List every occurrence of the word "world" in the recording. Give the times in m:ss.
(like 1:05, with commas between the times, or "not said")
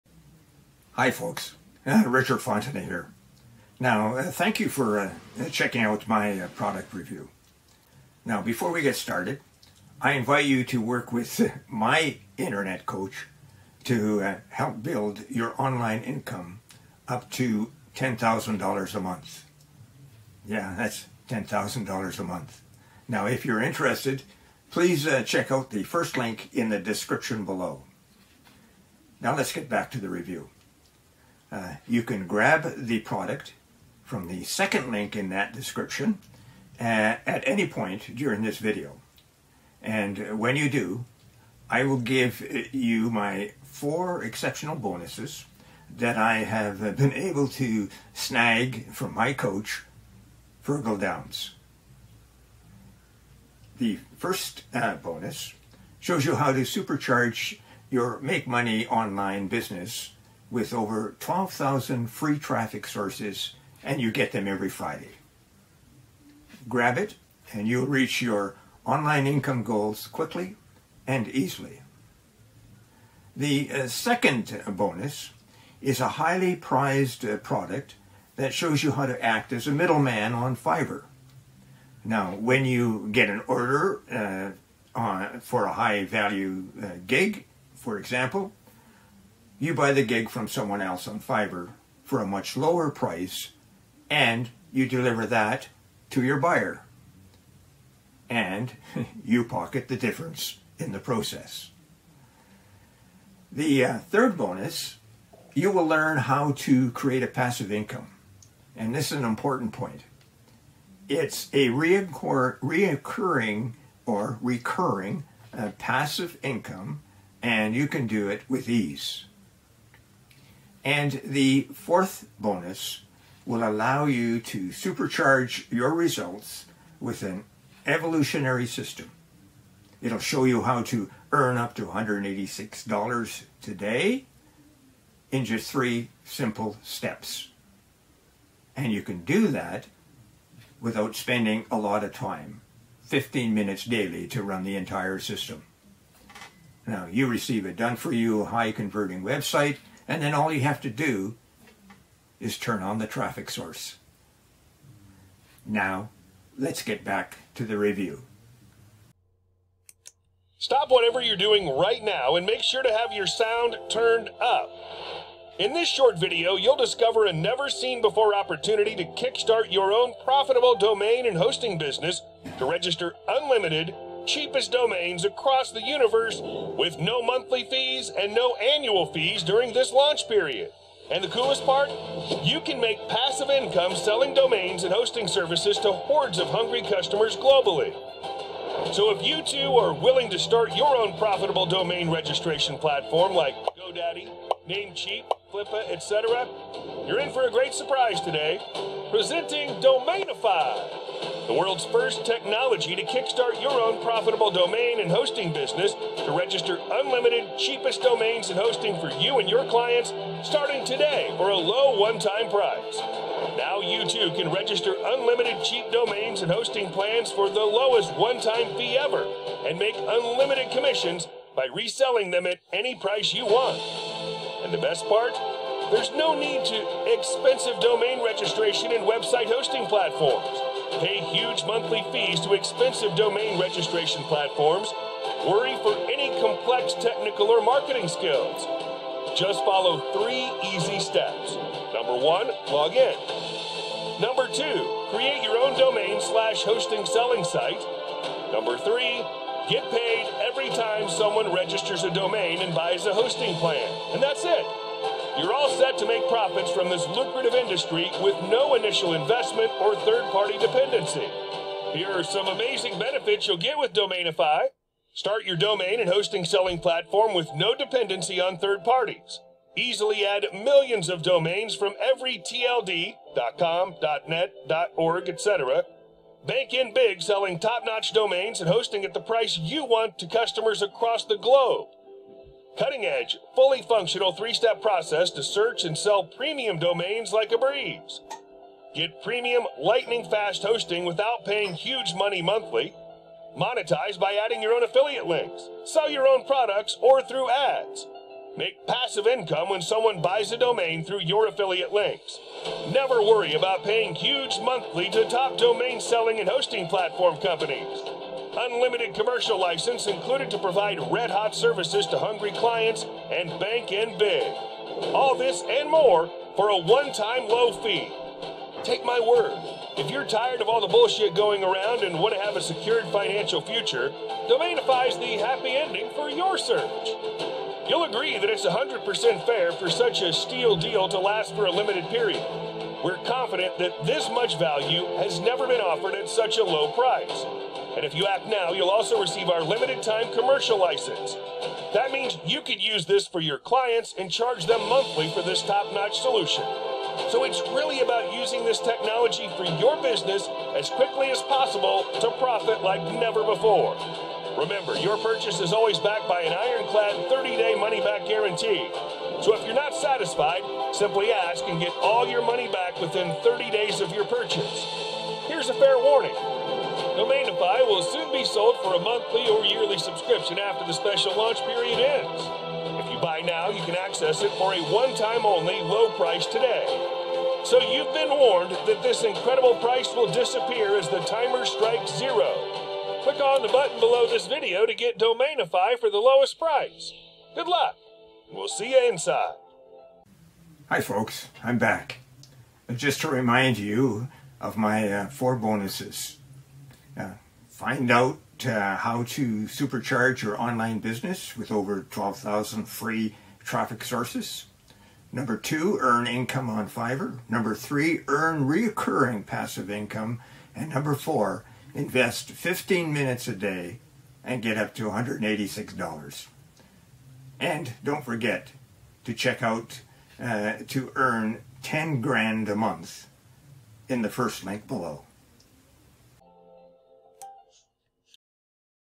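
3:21.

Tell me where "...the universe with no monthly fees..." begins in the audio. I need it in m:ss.
2:55.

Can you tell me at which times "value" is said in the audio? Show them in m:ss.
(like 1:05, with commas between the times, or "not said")
1:26, 5:34.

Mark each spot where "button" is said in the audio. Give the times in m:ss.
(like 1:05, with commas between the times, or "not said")
6:23.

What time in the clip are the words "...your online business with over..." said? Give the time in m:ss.
6:40.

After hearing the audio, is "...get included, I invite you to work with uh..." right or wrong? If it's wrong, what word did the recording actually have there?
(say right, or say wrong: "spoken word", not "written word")
wrong: "started", not "included".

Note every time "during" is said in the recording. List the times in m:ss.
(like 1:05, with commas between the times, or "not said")
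0:38, 2:59.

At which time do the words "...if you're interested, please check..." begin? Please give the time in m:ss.
0:23.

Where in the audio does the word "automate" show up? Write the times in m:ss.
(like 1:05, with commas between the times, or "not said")
not said.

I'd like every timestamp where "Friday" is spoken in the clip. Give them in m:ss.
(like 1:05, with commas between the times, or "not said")
1:04.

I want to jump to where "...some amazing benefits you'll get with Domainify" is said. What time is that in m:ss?
4:22.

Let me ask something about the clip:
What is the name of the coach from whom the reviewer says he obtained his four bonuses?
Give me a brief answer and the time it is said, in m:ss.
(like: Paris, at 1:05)
Virgil Downs, at 0:50.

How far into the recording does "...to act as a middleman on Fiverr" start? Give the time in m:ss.
1:19.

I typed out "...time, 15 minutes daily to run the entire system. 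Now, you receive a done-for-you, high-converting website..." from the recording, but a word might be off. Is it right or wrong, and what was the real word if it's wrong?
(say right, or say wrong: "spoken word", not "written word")
right.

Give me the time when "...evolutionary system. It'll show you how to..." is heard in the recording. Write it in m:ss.
2:07.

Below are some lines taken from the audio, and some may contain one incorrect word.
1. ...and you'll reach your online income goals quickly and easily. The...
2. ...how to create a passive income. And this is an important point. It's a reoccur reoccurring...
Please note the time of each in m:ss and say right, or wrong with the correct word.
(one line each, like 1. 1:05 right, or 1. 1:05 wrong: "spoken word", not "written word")
1. 1:07 right
2. 1:46 right.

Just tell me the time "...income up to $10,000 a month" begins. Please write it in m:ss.
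0:16.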